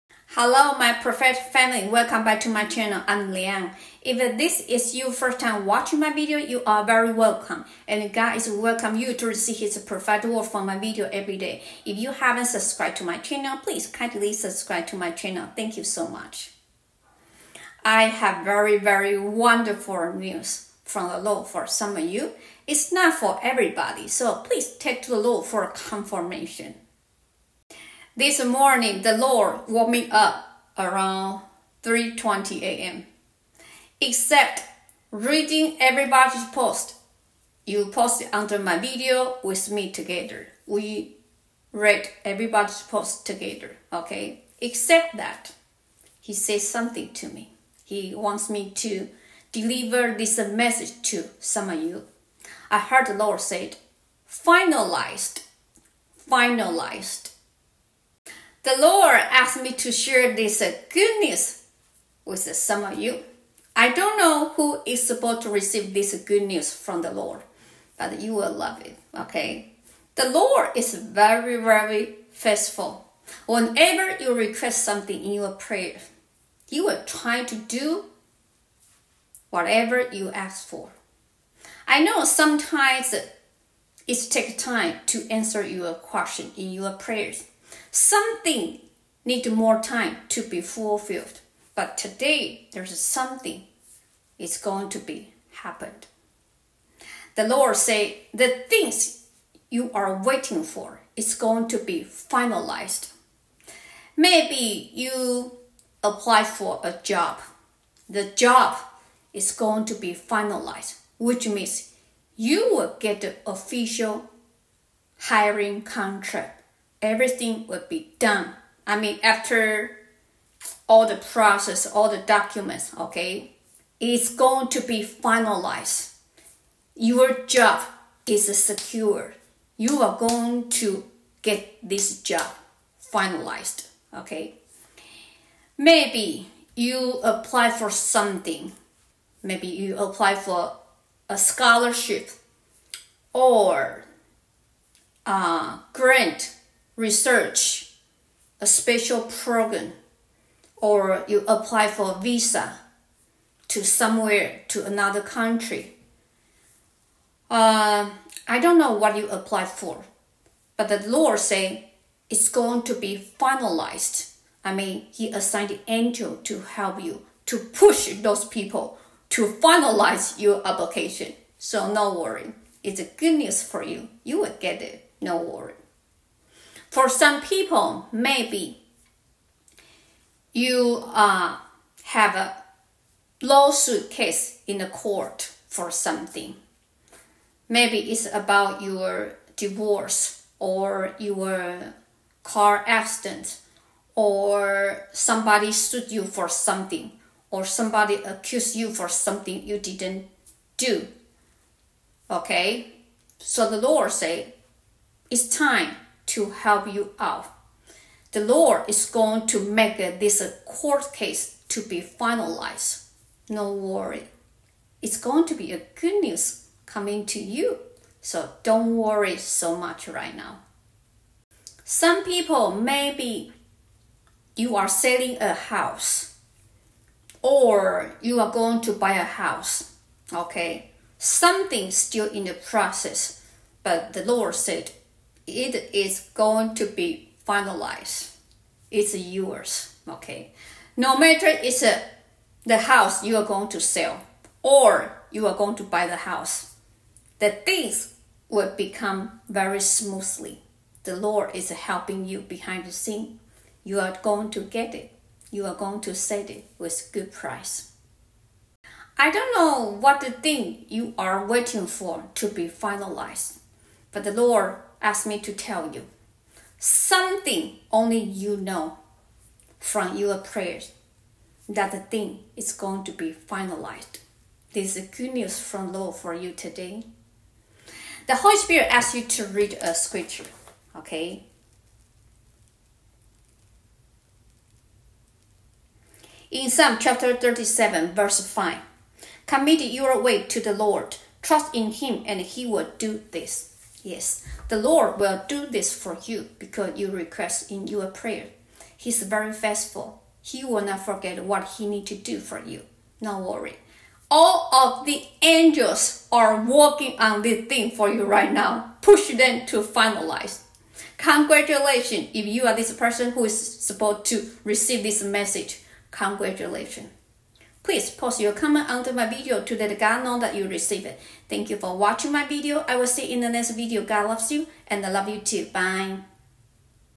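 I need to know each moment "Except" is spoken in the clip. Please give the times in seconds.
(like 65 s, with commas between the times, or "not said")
34 s, 44 s.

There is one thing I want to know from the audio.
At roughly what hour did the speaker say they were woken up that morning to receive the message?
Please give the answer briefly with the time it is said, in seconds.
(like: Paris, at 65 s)
3:20 a.m., at 31 s.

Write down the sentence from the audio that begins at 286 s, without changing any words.
In Psalm chapter 37, verse 5, commit your way to the Lord, trust in Him, and He will do this.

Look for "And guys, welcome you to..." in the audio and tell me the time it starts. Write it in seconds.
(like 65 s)
7 s.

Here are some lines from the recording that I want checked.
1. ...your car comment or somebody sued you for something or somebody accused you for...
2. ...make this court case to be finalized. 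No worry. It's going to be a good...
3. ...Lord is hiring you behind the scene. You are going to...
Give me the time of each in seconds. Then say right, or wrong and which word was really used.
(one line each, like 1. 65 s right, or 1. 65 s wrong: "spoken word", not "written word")
1. 191 s wrong: "accident", not "comment"
2. 209 s right
3. 251 s wrong: "helping", not "hiring".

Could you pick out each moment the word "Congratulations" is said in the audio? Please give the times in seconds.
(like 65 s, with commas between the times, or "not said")
311 s, 316 s.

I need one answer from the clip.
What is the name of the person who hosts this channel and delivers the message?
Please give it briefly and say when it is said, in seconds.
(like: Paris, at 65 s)
Liang, at 3 s.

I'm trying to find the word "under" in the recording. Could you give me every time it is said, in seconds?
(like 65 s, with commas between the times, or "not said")
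38 s, 318 s.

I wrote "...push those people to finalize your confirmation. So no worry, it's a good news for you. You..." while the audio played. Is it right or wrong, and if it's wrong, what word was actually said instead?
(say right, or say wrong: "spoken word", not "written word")
wrong: "application", not "confirmation".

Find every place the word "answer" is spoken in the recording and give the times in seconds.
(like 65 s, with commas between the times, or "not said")
85 s.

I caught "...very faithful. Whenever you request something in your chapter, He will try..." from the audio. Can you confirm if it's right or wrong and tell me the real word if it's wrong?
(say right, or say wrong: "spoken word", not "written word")
wrong: "prayer", not "chapter".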